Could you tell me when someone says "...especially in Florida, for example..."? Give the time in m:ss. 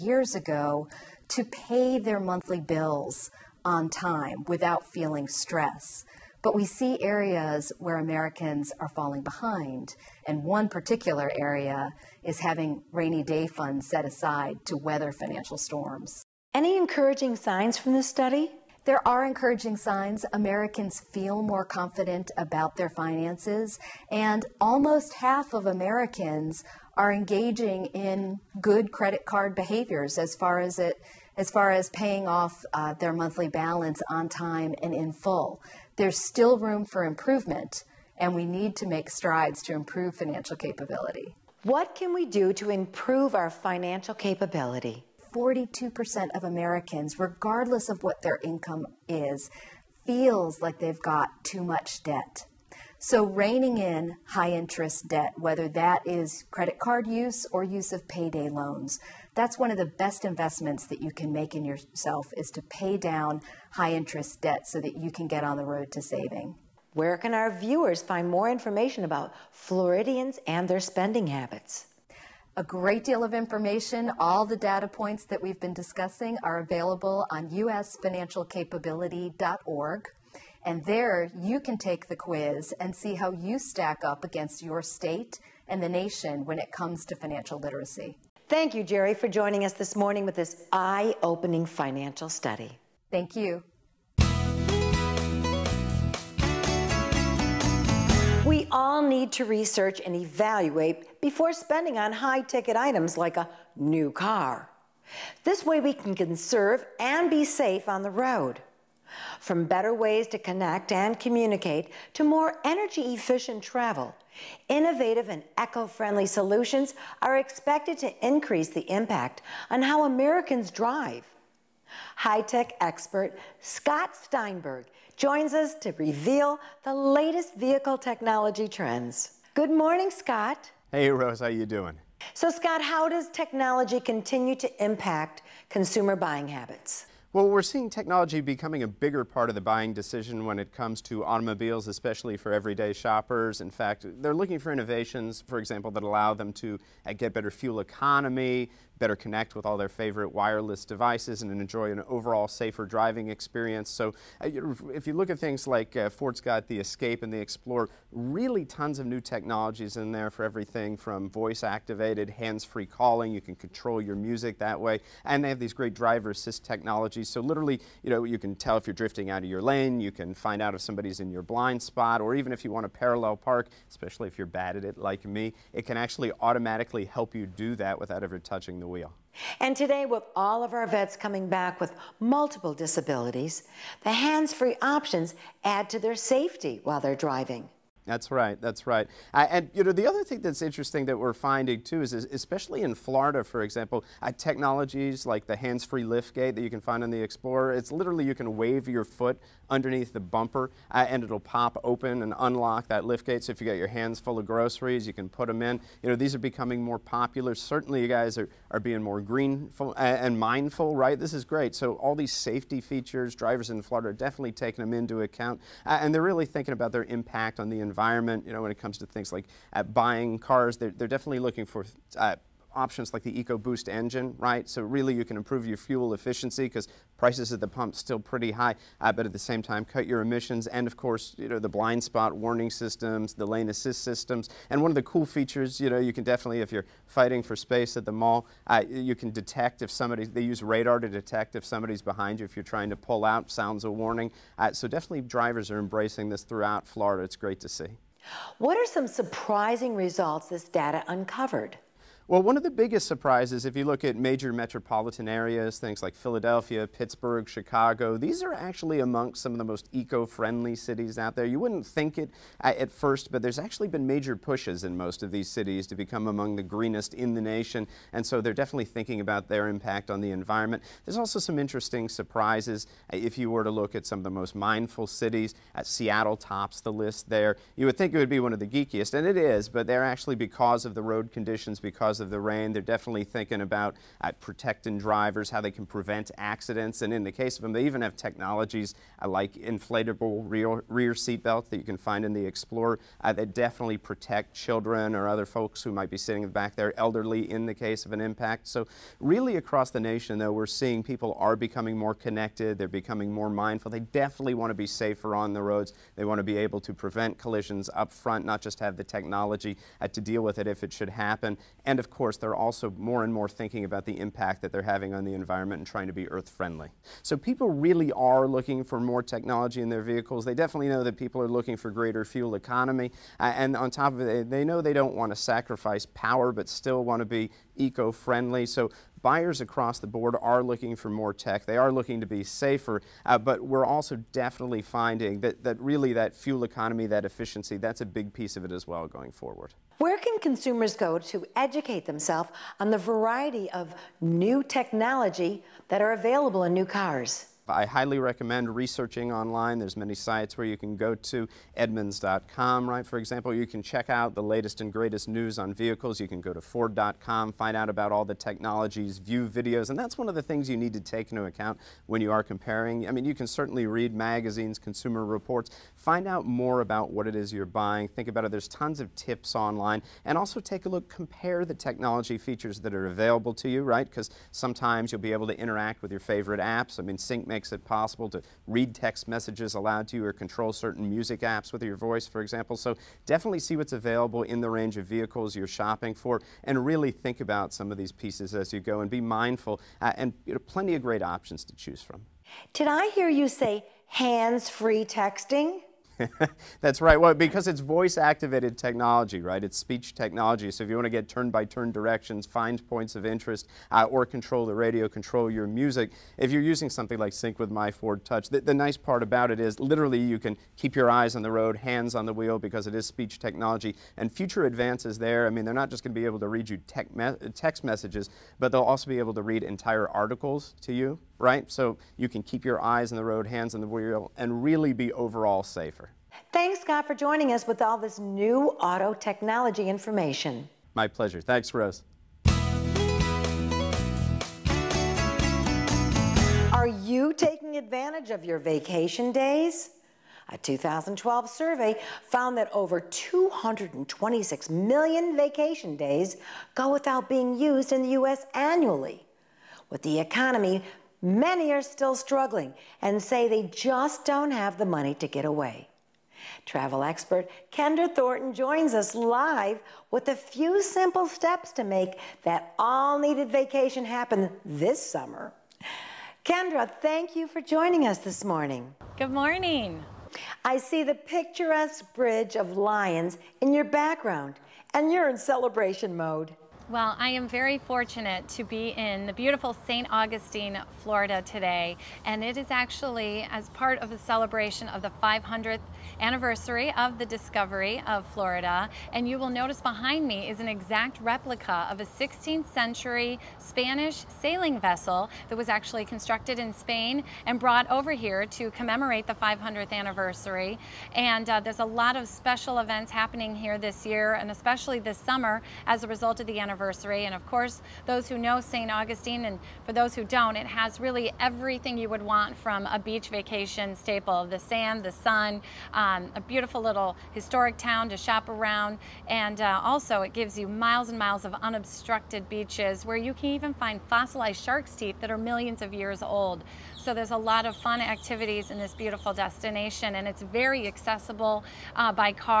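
3:12.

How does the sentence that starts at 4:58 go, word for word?
So really across the nation, though, we're seeing people are becoming more connected.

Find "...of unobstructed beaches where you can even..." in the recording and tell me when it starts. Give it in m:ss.
8:41.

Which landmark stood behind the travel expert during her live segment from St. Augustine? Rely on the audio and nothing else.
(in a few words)
Bridge of Lions.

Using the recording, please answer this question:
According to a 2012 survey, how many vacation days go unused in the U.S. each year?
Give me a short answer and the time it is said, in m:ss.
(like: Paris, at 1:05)
226 million, at 7:22.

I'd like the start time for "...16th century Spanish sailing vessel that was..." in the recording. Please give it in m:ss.
8:12.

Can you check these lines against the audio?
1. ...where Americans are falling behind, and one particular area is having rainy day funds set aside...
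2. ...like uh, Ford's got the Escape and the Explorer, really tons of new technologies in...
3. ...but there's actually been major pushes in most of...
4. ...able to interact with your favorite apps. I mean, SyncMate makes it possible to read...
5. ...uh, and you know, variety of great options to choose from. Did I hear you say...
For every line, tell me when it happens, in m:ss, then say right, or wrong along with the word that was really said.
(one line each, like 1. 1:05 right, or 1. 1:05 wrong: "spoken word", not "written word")
1. 0:07 right
2. 2:35 right
3. 4:23 right
4. 6:15 right
5. 6:30 wrong: "plenty", not "variety".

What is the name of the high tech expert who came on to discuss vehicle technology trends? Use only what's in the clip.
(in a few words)
Scott Steinberg.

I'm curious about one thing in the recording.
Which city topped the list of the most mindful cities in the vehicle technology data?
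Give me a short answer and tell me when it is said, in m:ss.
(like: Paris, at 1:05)
Seattle, at 4:35.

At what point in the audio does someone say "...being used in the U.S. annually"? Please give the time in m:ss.
7:27.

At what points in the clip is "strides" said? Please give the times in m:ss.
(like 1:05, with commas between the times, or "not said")
0:39.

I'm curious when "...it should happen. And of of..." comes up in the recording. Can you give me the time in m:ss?
5:10.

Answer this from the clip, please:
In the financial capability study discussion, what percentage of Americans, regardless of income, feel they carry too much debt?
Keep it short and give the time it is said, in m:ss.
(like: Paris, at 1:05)
42%, at 0:45.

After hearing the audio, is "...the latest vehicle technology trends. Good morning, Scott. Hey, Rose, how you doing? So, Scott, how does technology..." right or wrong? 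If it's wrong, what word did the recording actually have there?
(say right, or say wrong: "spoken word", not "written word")
right.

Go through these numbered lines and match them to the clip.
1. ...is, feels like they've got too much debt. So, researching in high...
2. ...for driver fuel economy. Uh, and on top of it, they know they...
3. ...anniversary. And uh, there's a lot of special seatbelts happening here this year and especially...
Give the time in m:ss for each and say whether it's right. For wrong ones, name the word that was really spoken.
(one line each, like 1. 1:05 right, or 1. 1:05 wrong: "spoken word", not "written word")
1. 0:49 wrong: "reining", not "researching"
2. 5:21 wrong: "greater", not "driver"
3. 8:19 wrong: "events", not "seatbelts".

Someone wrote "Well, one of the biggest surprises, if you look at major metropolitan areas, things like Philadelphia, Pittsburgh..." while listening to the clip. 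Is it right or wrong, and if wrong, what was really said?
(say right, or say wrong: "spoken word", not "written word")
right.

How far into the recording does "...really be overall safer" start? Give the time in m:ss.
7:04.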